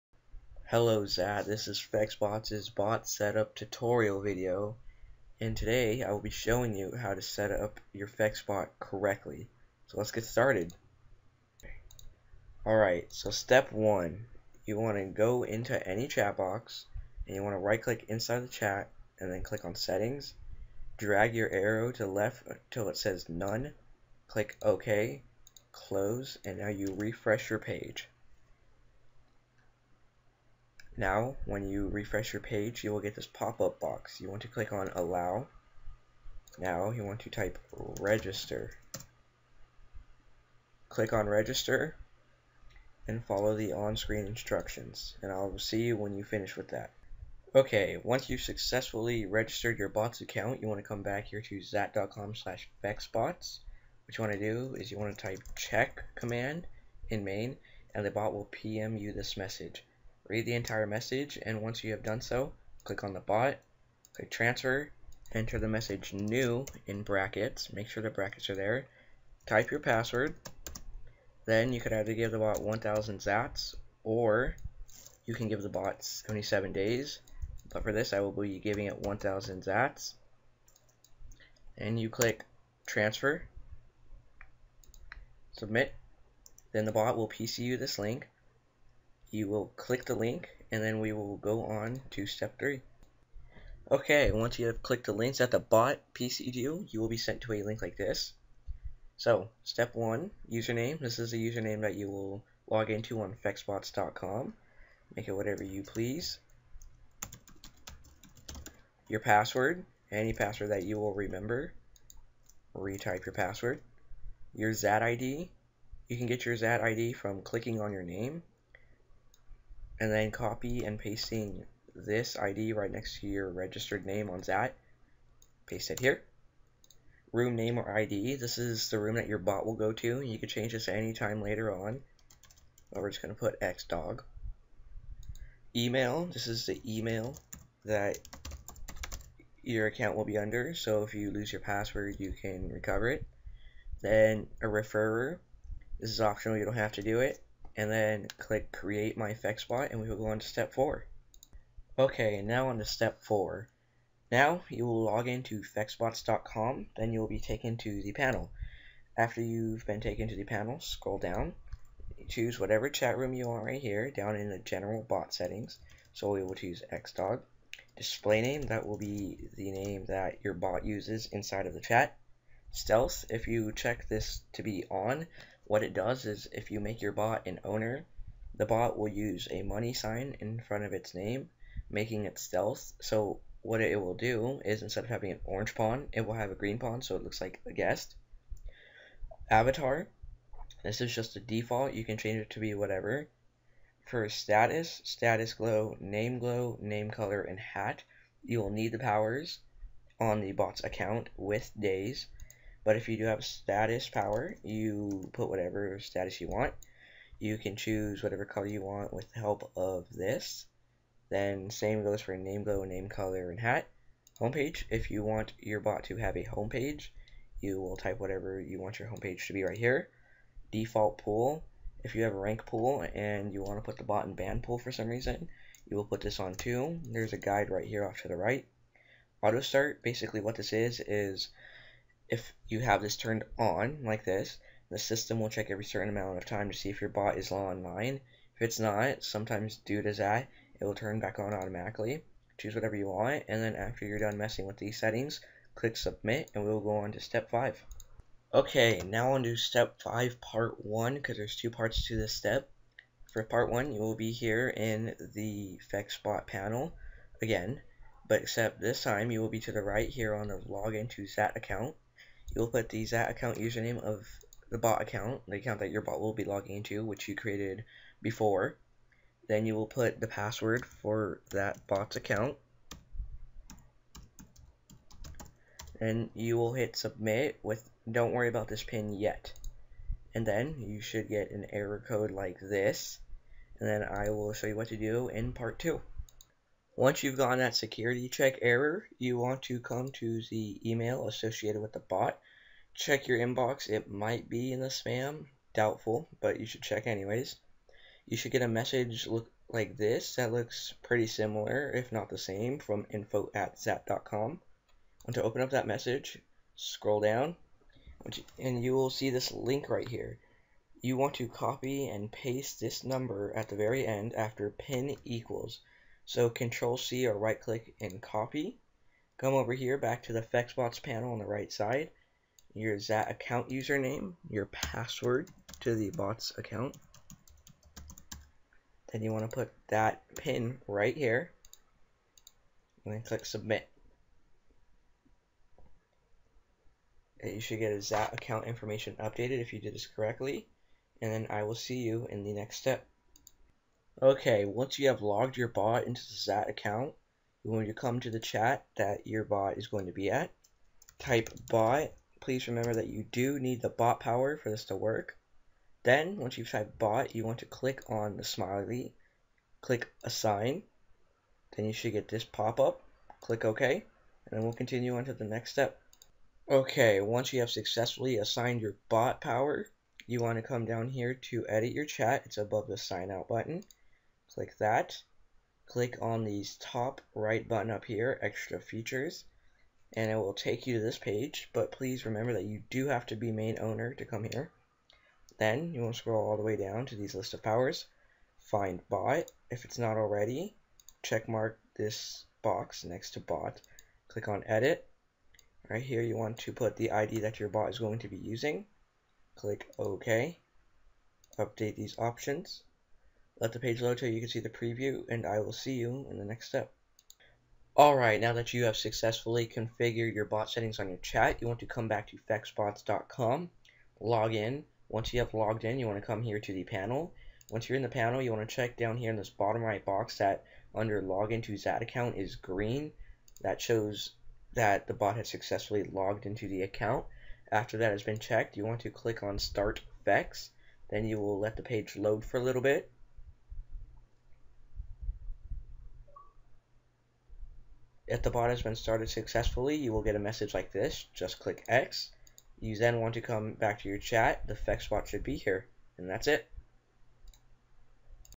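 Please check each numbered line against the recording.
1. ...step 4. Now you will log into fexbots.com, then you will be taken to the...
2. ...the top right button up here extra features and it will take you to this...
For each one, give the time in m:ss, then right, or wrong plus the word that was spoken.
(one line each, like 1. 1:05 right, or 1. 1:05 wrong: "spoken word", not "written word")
1. 2:32 right
2. 6:16 right.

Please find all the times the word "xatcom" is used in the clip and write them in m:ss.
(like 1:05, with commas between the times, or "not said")
0:51, 5:03.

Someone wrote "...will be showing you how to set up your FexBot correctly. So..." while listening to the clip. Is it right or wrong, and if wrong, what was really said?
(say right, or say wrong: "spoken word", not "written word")
right.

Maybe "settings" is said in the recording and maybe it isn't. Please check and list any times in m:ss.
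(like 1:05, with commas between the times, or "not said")
0:19, 2:45, 4:04, 6:50.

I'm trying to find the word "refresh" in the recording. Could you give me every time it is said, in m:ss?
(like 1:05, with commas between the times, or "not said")
0:26, 0:31.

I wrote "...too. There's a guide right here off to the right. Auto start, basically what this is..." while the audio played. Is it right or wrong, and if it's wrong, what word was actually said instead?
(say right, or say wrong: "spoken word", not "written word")
right.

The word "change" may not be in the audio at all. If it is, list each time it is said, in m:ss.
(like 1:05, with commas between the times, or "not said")
2:10, 3:12.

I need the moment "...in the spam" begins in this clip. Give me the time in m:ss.
4:54.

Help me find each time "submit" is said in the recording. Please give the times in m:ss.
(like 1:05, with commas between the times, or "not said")
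1:25, 4:05, 4:36, 5:33.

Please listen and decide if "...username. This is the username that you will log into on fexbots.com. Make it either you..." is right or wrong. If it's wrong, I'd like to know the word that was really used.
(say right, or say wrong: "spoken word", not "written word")
wrong: "whatever", not "either".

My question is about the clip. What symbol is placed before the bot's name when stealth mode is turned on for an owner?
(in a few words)
money sign.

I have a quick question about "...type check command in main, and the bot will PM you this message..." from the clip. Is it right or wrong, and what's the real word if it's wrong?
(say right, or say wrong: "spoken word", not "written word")
right.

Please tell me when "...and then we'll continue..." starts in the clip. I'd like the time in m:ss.
6:03.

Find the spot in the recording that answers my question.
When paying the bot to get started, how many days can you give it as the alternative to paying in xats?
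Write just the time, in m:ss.
1:16.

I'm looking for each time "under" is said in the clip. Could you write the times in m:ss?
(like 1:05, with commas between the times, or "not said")
2:20, 7:00.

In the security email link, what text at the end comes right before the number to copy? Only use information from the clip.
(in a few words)
pin equals.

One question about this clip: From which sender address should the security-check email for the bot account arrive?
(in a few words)
info at xat.com.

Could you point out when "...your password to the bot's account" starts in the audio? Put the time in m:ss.
5:24.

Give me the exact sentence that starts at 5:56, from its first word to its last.
Then, once you've typed bot, you want to click on the smiley, click assign.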